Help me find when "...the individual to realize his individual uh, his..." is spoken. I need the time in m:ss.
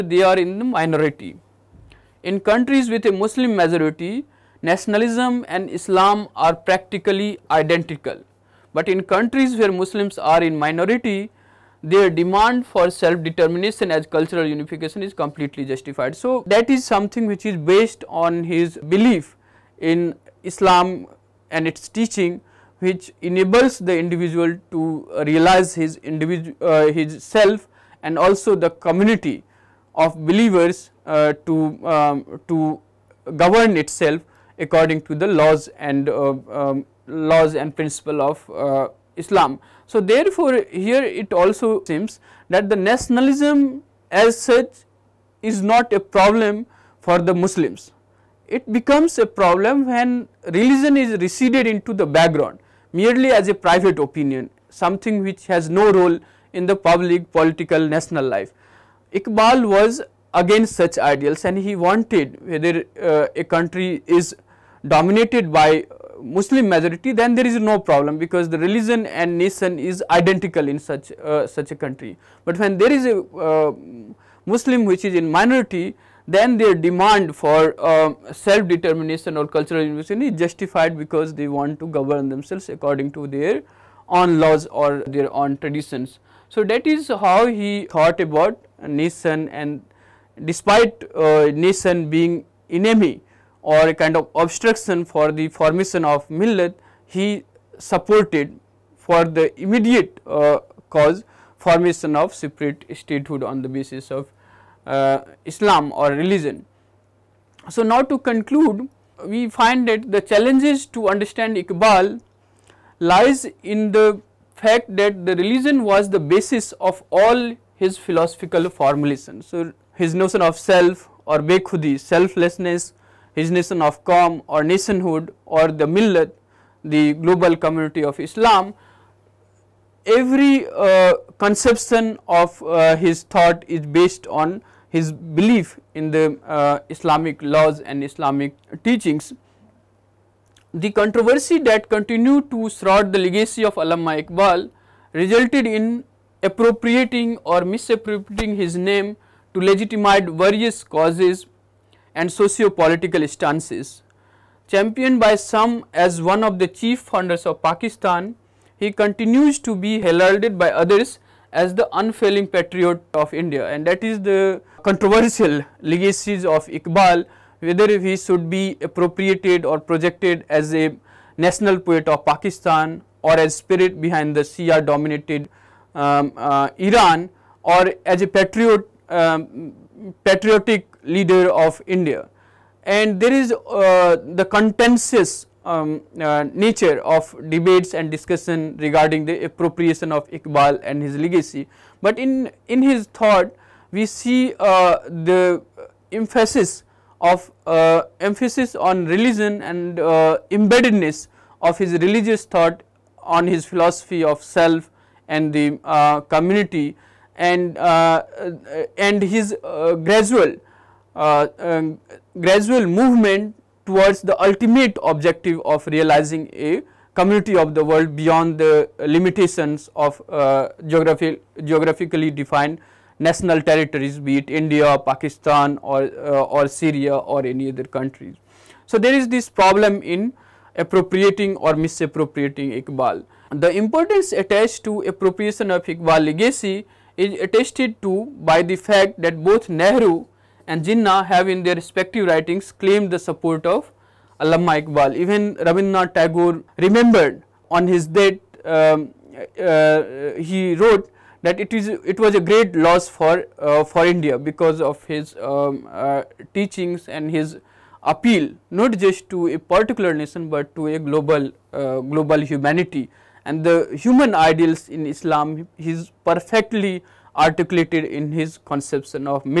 0:23.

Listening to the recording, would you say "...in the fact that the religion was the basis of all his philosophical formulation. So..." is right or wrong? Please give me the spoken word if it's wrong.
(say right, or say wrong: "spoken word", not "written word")
right.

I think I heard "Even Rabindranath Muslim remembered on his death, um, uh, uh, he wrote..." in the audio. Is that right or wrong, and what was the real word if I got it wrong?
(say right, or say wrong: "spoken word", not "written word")
wrong: "Tagore", not "Muslim".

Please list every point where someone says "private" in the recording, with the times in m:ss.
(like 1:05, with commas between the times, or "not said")
0:53.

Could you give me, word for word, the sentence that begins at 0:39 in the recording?
So, therefore, here it also seems that the nationalism as such is not a problem for the Muslims.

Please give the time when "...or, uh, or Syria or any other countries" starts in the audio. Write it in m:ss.
3:45.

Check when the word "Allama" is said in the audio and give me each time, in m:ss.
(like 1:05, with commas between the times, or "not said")
2:23, 4:04.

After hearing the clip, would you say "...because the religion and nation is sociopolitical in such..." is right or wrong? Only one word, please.
wrong.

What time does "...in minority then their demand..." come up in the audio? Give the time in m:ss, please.
1:15.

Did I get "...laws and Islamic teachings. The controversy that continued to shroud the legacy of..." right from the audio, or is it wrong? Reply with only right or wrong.
right.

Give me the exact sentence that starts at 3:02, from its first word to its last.
And there is uh, the contentious um, uh, nature of debates and discussion regarding the appropriation of Iqbal and his legacy.